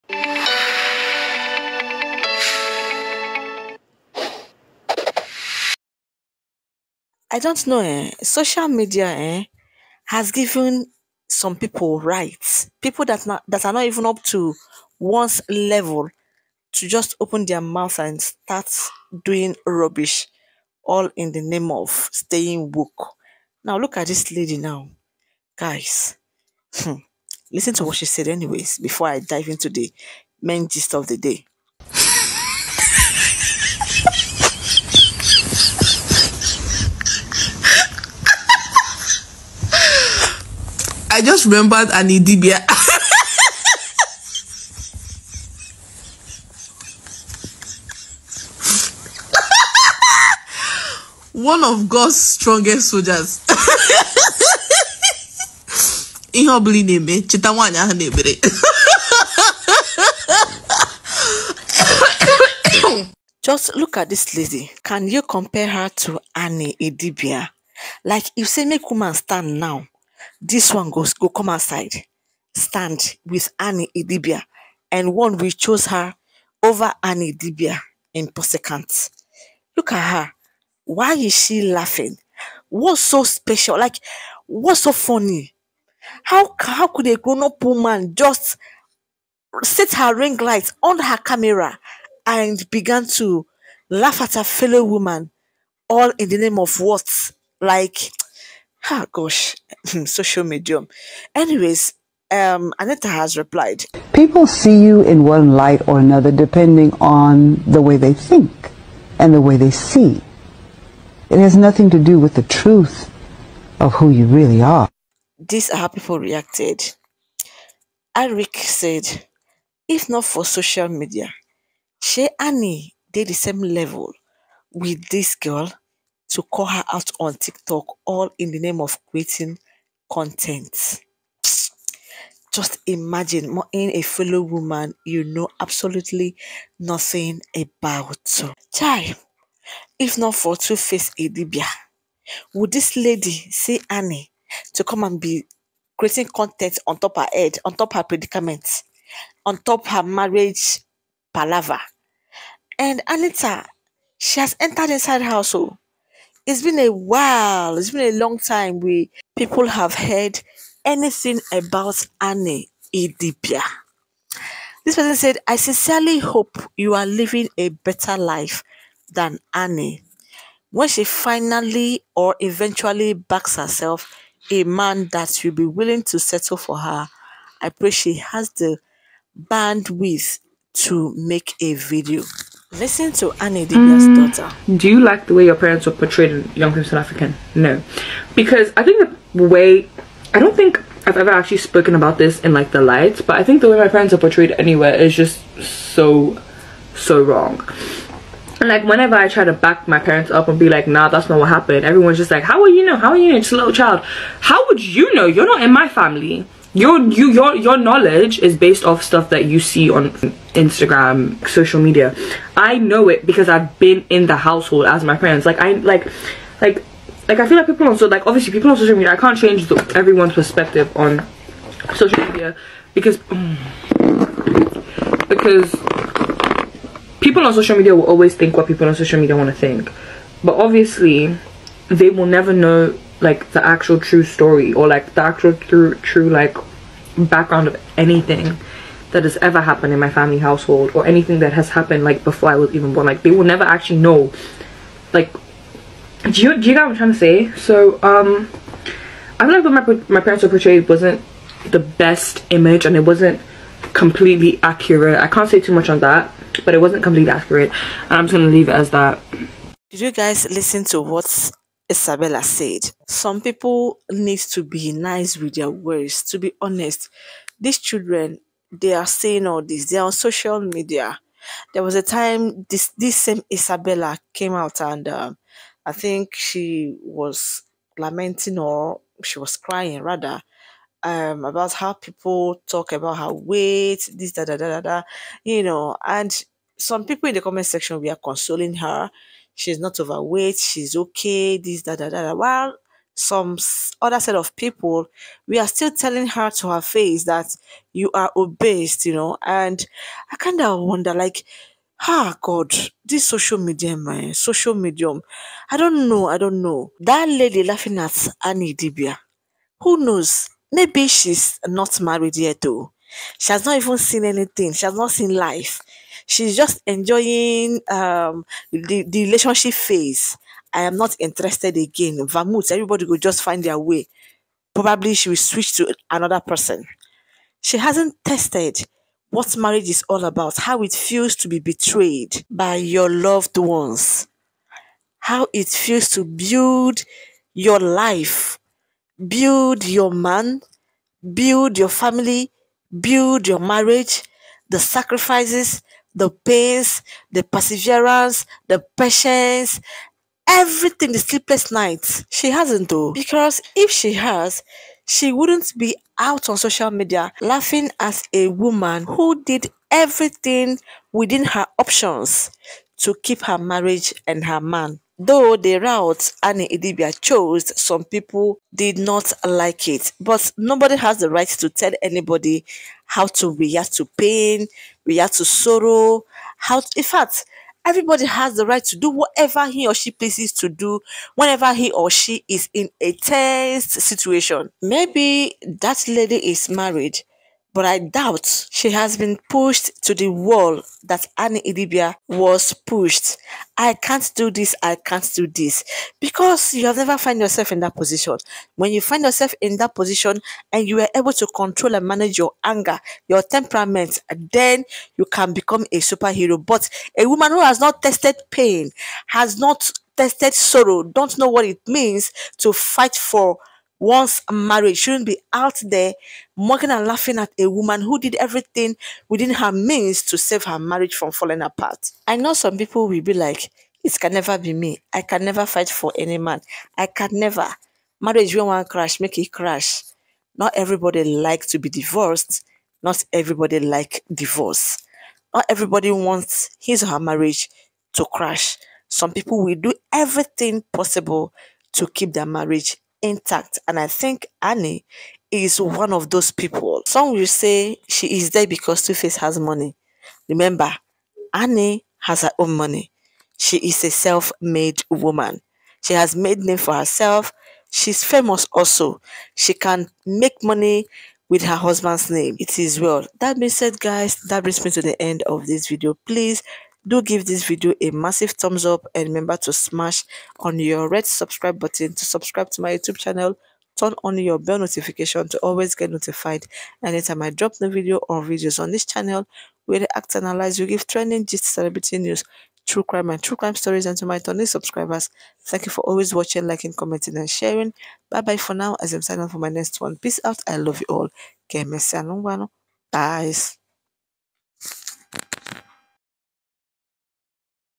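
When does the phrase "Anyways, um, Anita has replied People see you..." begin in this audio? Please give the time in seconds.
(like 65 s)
101 s.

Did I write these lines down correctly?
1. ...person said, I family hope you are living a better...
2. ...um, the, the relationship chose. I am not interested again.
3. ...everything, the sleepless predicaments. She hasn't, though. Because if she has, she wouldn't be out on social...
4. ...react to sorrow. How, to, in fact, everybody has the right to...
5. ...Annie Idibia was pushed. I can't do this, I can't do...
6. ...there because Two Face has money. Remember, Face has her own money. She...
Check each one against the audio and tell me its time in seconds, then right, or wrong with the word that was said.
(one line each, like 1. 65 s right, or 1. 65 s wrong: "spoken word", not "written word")
1. 164 s wrong: "sincerely", not "family"
2. 317 s wrong: "phase", not "chose"
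3. 350 s wrong: "nights", not "predicaments"
4. 375 s right
5. 391 s right
6. 448 s wrong: "Annie", not "Face".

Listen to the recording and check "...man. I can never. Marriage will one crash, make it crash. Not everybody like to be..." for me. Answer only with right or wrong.
right.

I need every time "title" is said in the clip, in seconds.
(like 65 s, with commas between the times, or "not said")
not said.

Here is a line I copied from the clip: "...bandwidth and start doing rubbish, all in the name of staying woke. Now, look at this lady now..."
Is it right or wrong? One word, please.
wrong.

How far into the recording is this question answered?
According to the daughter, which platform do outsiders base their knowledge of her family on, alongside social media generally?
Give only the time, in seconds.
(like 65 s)
210 s.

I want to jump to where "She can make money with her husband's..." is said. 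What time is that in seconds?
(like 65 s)
459 s.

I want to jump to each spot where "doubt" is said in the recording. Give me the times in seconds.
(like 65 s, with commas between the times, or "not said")
387 s.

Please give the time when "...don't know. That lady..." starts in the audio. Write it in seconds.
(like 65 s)
306 s.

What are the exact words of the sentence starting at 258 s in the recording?
And I'm just going to leave it as that.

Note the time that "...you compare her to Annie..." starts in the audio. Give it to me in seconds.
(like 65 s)
65 s.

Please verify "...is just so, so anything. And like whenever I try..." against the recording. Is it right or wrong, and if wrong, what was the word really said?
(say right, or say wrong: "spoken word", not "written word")
wrong: "wrong", not "anything".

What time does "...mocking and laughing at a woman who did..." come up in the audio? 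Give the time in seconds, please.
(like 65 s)
416 s.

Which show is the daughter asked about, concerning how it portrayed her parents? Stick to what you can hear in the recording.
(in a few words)
Young Famous African.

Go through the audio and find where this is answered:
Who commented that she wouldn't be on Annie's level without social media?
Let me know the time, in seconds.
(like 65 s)
118 s.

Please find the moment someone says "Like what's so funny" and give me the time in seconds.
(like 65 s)
83 s.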